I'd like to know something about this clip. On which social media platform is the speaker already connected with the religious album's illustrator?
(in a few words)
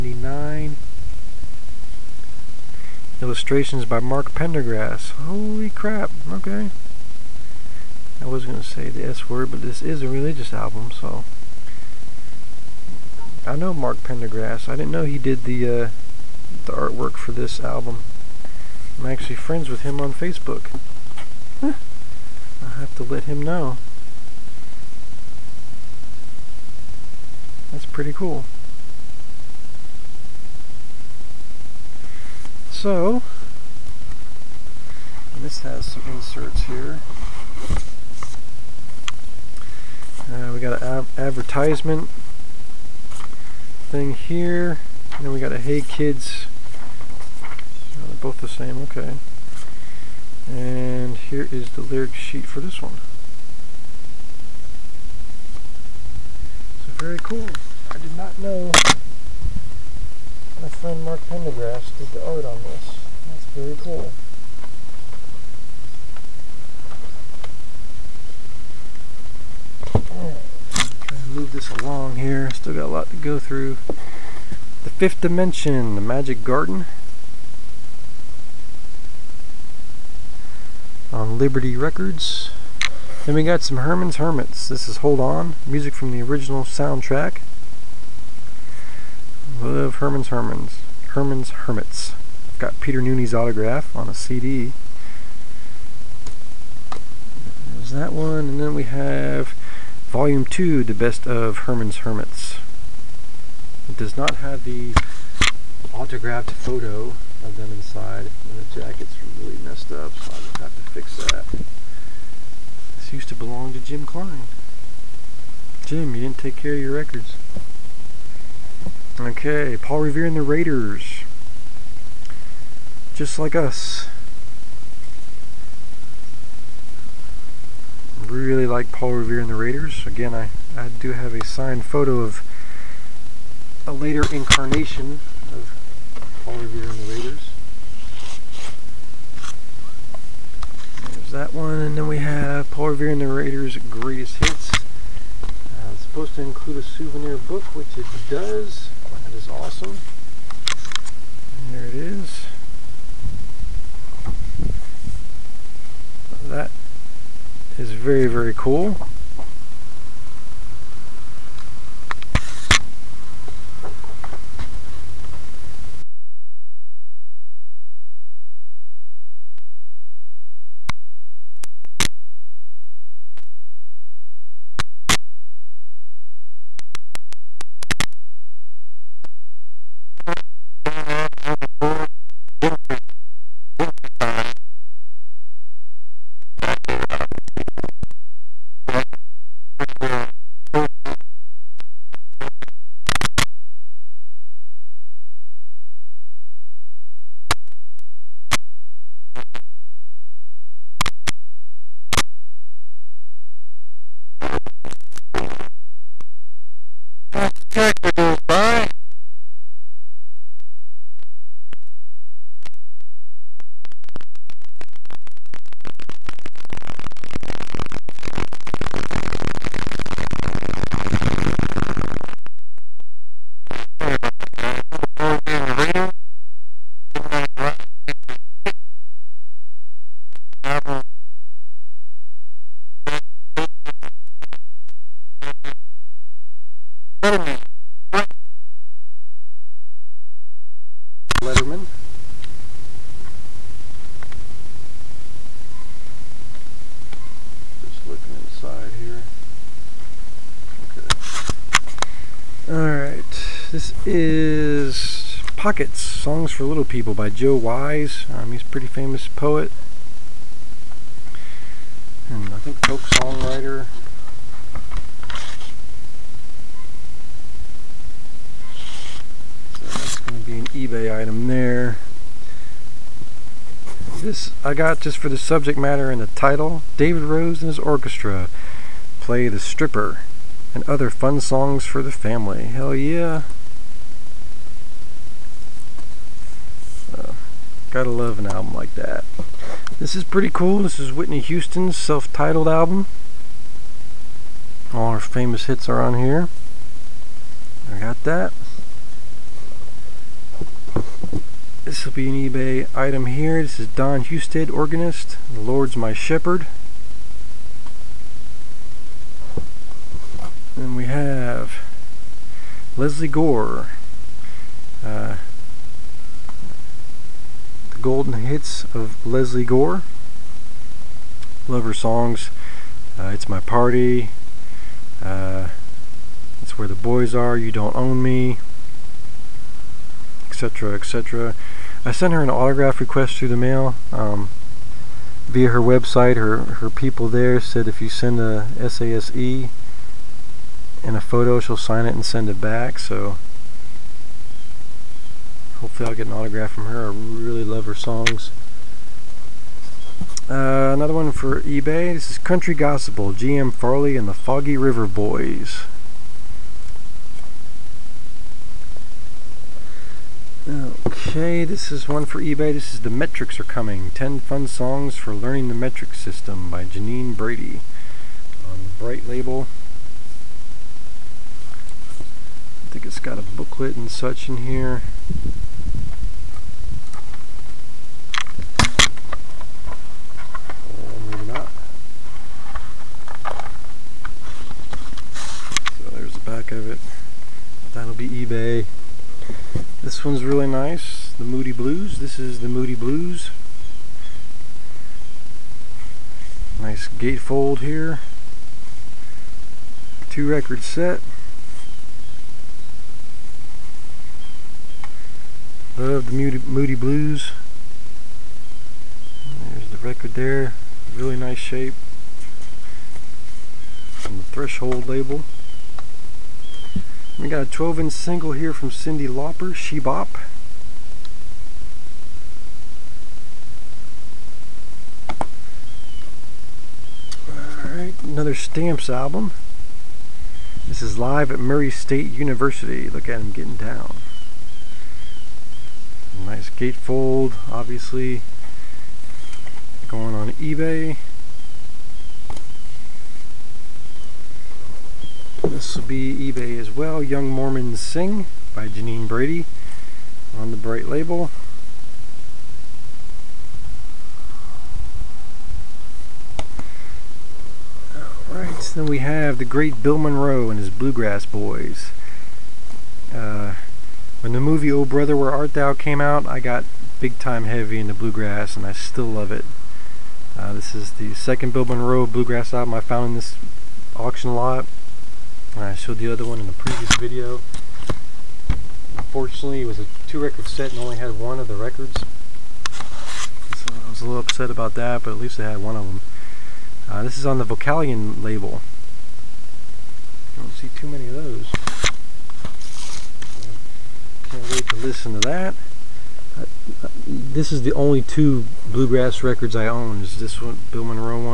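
Facebook.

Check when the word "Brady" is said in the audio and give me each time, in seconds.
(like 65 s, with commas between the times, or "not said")
367 s, 449 s.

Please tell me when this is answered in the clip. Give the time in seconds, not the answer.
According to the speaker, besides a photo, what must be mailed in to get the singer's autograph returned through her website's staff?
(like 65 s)
338 s.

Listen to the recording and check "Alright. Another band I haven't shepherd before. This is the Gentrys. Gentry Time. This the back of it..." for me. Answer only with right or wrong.
wrong.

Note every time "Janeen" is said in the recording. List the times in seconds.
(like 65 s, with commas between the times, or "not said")
366 s, 448 s.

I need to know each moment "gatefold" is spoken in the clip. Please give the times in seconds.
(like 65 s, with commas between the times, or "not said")
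397 s, 436 s.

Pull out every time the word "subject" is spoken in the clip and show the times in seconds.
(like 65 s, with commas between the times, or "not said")
275 s.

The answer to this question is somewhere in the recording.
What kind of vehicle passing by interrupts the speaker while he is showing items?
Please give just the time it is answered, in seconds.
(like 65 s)
207 s.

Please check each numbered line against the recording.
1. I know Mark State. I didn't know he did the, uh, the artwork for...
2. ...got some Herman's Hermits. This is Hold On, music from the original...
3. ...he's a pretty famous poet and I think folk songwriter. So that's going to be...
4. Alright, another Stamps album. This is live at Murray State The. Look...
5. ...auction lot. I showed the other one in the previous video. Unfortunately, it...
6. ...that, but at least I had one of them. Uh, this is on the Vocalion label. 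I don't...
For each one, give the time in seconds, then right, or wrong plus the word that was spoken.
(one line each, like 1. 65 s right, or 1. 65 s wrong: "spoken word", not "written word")
1. 13 s wrong: "Pendergrass", not "State"
2. 83 s right
3. 258 s right
4. 427 s wrong: "University", not "The"
5. 474 s right
6. 484 s right.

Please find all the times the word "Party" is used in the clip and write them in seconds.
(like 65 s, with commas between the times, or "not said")
323 s.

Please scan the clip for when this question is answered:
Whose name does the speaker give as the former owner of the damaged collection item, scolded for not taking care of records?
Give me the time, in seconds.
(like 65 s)
113 s.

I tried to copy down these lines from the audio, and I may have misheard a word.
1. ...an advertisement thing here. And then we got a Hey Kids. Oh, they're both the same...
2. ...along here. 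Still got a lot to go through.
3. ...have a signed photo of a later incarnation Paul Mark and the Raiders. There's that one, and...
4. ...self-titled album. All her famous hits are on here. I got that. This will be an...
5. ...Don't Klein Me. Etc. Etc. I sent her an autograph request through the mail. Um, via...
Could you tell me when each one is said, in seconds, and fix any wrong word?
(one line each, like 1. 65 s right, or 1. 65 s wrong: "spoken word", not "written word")
1. 40 s right
2. 71 s right
3. 131 s wrong: "Revere", not "Mark"
4. 291 s right
5. 327 s wrong: "Own", not "Klein".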